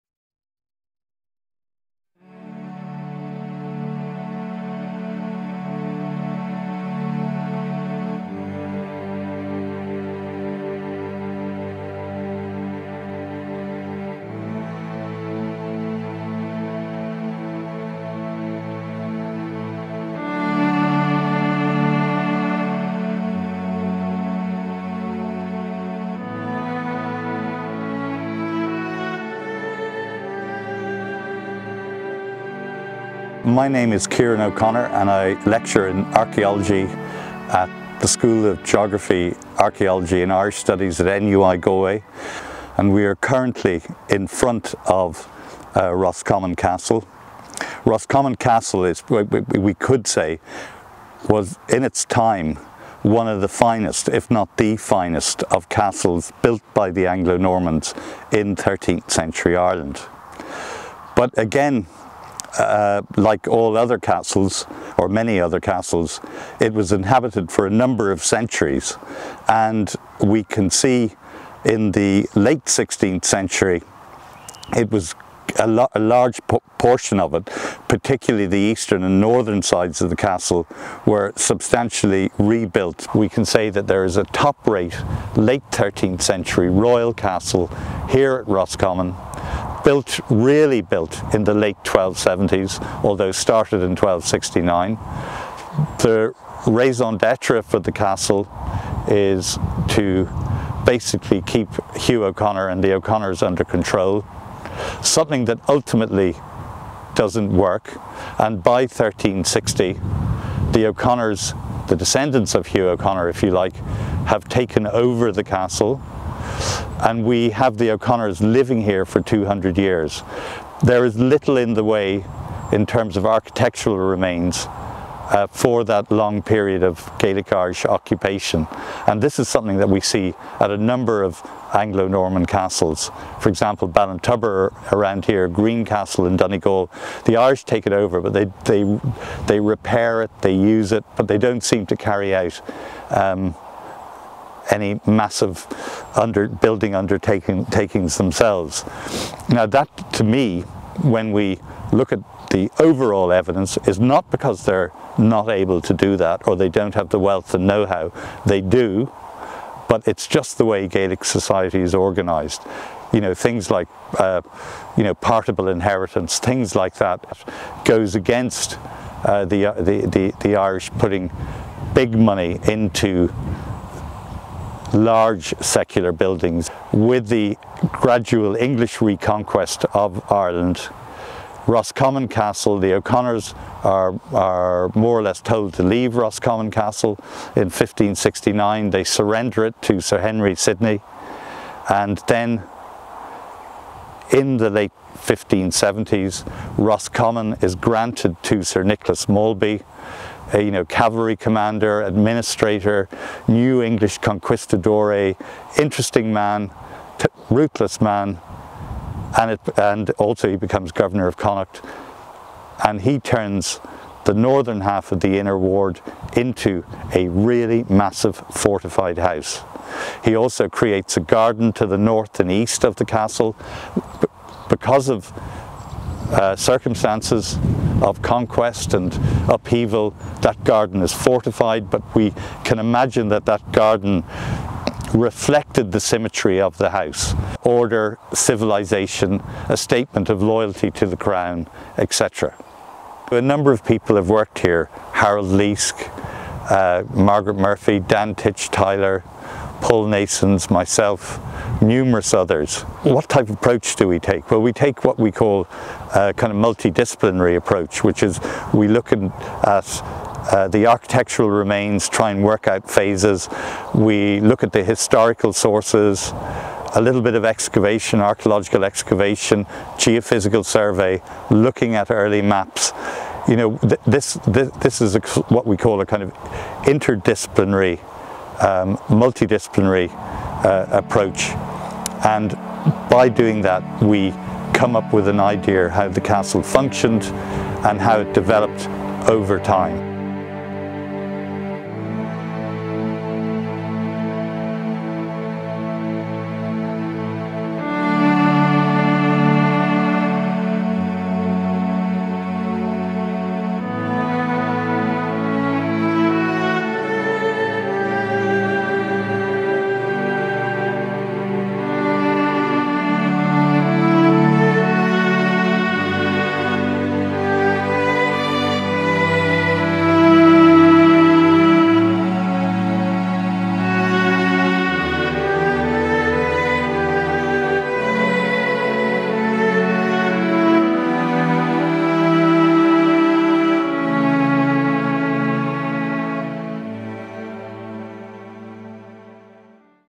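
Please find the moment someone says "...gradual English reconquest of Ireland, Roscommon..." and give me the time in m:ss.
2:57.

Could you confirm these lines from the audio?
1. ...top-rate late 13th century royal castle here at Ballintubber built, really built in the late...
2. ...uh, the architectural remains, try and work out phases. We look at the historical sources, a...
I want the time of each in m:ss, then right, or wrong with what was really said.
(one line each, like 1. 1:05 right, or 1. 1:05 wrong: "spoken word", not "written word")
1. 1:24 wrong: "Roscommon", not "Ballintubber"
2. 4:19 right.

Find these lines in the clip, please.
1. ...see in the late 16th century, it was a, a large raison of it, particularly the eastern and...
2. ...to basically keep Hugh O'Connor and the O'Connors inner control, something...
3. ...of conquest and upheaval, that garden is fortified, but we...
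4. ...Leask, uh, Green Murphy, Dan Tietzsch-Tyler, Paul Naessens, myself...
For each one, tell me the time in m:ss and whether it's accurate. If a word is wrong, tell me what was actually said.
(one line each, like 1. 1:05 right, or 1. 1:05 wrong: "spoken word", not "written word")
1. 1:10 wrong: "portion", not "raison"
2. 1:39 wrong: "under", not "inner"
3. 3:48 right
4. 4:05 wrong: "Margaret", not "Green".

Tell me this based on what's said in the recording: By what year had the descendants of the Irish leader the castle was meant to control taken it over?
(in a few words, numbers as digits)
1360.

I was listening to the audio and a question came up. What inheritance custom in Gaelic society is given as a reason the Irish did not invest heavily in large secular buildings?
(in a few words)
Partible inheritance.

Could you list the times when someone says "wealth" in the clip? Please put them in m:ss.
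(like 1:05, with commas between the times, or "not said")
2:37.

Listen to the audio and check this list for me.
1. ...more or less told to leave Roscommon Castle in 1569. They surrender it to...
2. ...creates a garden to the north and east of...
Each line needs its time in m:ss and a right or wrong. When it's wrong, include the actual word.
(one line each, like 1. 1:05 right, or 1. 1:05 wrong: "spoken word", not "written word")
1. 3:04 right
2. 3:40 right.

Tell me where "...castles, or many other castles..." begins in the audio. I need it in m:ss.
1:03.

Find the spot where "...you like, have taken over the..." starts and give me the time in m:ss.
1:53.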